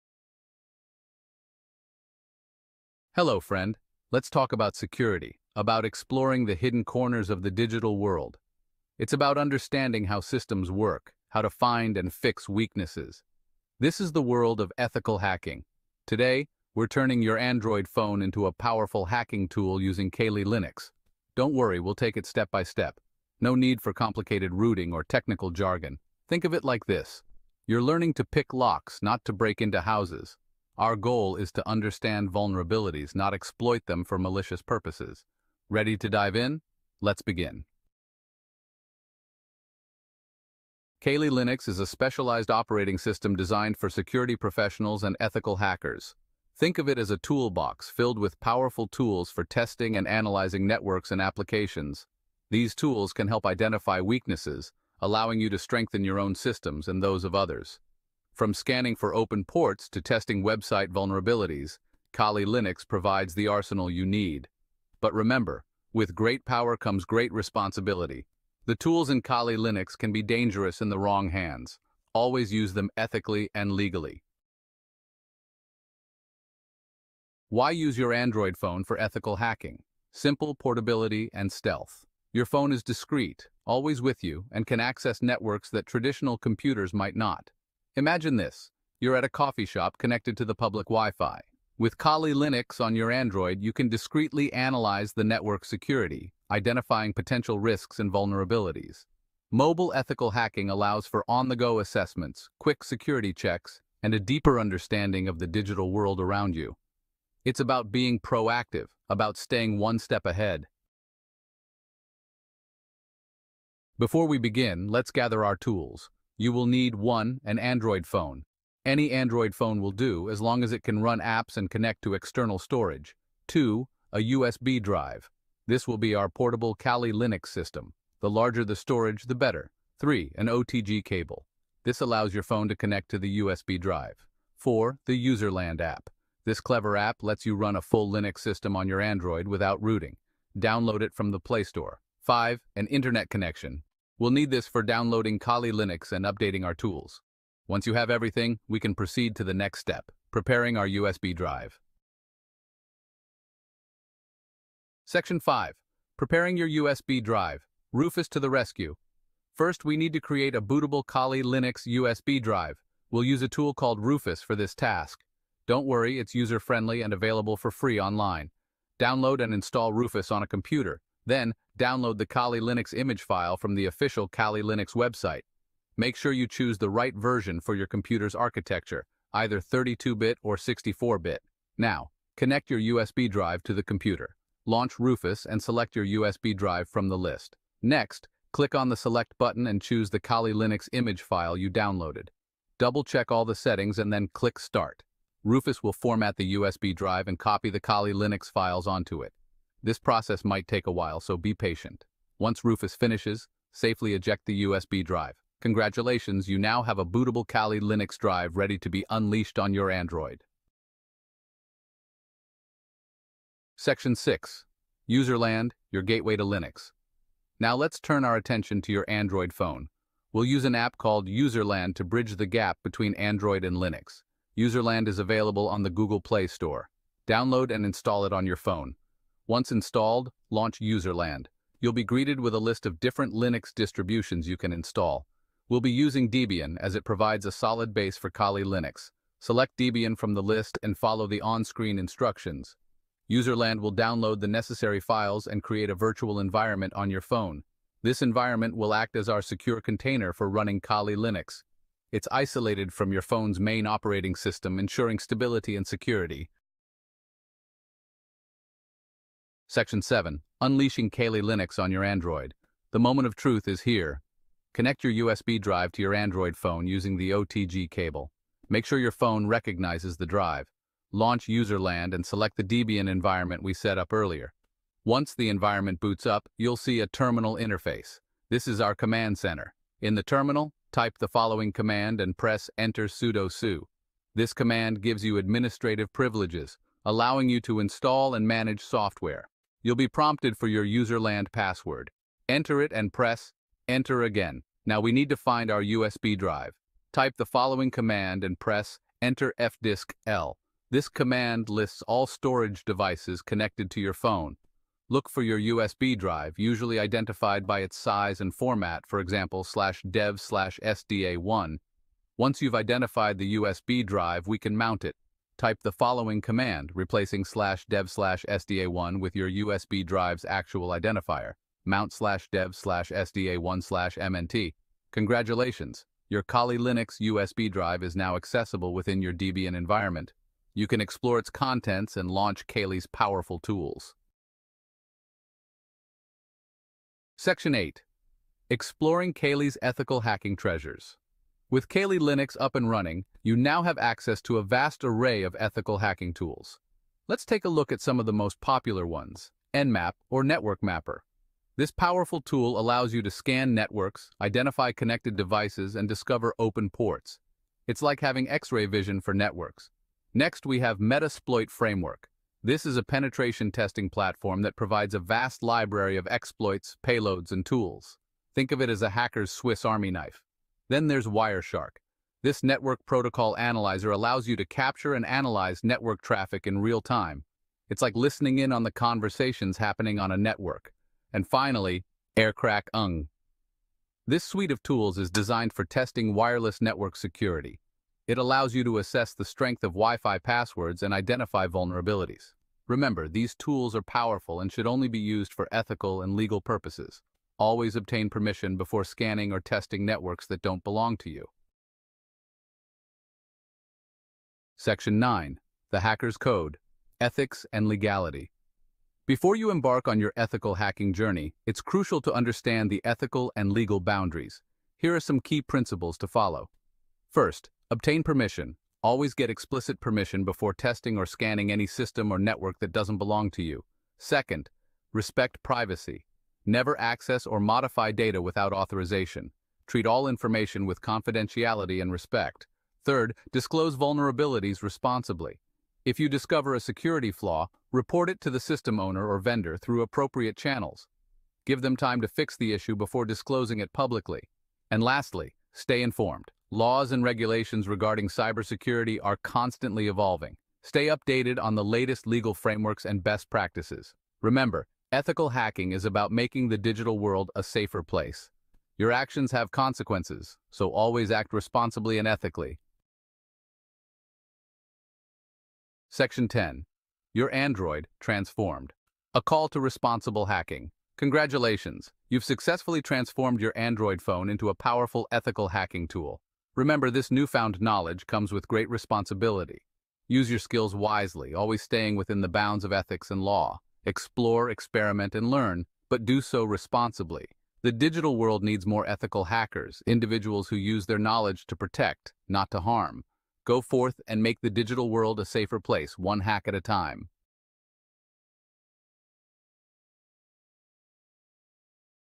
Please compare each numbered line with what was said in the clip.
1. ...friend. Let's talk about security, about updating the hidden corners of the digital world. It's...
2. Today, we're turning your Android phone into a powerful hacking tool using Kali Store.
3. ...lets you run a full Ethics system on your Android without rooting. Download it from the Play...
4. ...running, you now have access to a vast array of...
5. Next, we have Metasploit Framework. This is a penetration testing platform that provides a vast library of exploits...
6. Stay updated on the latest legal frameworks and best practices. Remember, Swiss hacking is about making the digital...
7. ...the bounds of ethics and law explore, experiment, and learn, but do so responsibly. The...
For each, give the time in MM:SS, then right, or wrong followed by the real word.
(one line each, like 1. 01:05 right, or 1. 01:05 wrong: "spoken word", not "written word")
1. 00:03 wrong: "exploring", not "updating"
2. 00:16 wrong: "Linux", not "Store"
3. 02:17 wrong: "Linux", not "Ethics"
4. 05:42 right
5. 06:00 right
6. 07:30 wrong: "Ethical", not "Swiss"
7. 08:02 right.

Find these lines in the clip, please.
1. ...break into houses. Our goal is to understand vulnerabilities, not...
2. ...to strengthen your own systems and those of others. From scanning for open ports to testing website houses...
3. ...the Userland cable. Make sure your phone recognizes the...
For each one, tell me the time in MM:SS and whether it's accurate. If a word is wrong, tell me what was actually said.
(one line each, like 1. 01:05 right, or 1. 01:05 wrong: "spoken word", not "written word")
1. 00:29 right
2. 00:55 wrong: "vulnerabilities", not "houses"
3. 04:27 wrong: "OTG", not "Userland".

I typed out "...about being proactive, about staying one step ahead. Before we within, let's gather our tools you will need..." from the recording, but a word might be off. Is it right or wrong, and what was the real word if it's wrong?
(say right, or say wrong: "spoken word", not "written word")
wrong: "begin", not "within".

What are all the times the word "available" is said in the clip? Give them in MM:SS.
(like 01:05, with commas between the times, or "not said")
02:47, 03:45.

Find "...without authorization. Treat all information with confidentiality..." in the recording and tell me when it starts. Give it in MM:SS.
07:08.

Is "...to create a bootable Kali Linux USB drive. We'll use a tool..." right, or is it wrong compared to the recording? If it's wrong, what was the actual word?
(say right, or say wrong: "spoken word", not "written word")
right.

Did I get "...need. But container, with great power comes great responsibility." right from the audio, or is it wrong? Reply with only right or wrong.
wrong.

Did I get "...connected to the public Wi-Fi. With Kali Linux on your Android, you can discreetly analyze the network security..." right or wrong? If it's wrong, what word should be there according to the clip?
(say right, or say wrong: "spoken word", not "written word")
right.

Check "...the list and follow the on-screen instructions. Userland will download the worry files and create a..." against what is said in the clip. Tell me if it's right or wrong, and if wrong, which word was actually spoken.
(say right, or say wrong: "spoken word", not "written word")
wrong: "necessary", not "worry".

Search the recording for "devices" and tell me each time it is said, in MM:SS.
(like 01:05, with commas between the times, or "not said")
05:02, 05:55.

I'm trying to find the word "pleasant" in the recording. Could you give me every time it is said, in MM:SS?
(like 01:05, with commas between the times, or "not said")
not said.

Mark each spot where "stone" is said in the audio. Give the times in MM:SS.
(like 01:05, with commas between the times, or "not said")
not said.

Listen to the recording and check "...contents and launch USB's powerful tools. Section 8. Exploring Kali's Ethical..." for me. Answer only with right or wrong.
wrong.